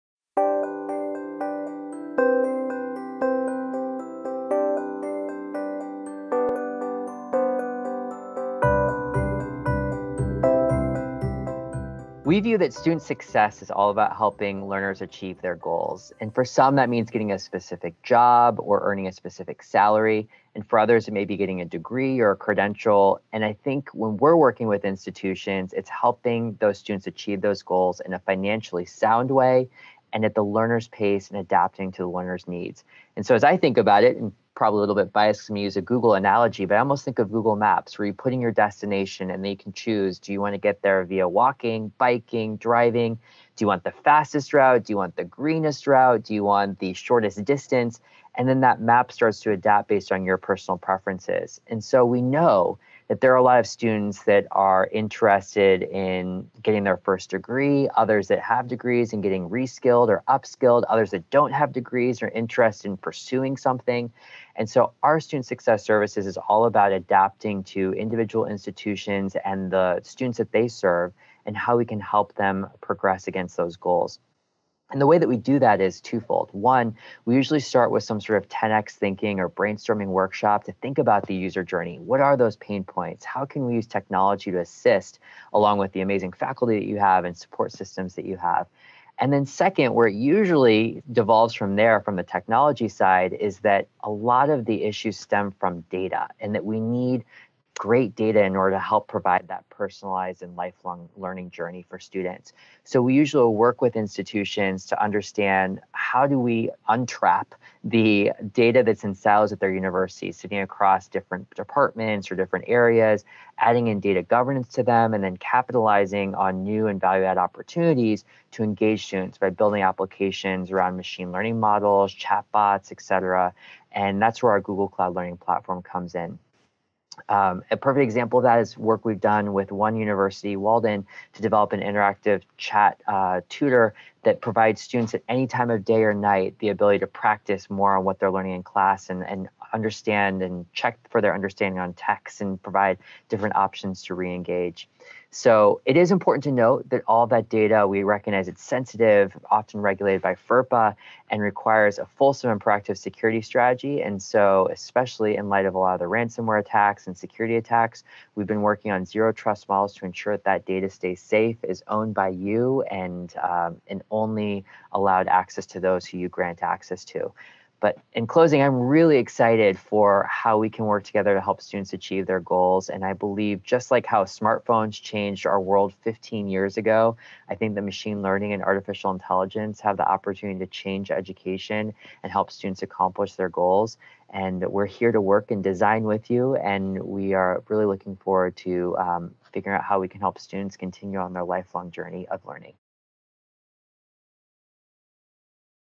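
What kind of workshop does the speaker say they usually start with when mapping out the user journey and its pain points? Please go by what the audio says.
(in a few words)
10x thinking.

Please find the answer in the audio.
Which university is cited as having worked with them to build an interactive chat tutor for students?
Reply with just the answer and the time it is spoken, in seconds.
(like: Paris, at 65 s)
Walden, at 130 s.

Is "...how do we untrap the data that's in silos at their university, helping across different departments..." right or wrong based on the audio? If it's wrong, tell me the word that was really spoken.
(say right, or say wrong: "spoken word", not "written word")
wrong: "sitting", not "helping".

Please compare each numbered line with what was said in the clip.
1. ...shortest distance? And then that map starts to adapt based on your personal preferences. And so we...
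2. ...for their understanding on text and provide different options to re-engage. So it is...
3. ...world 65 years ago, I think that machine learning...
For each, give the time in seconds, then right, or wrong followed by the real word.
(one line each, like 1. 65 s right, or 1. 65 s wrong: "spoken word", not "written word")
1. 46 s right
2. 141 s right
3. 175 s wrong: "15", not "65".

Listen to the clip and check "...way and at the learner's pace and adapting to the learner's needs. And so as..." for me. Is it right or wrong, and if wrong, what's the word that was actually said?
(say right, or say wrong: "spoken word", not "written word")
right.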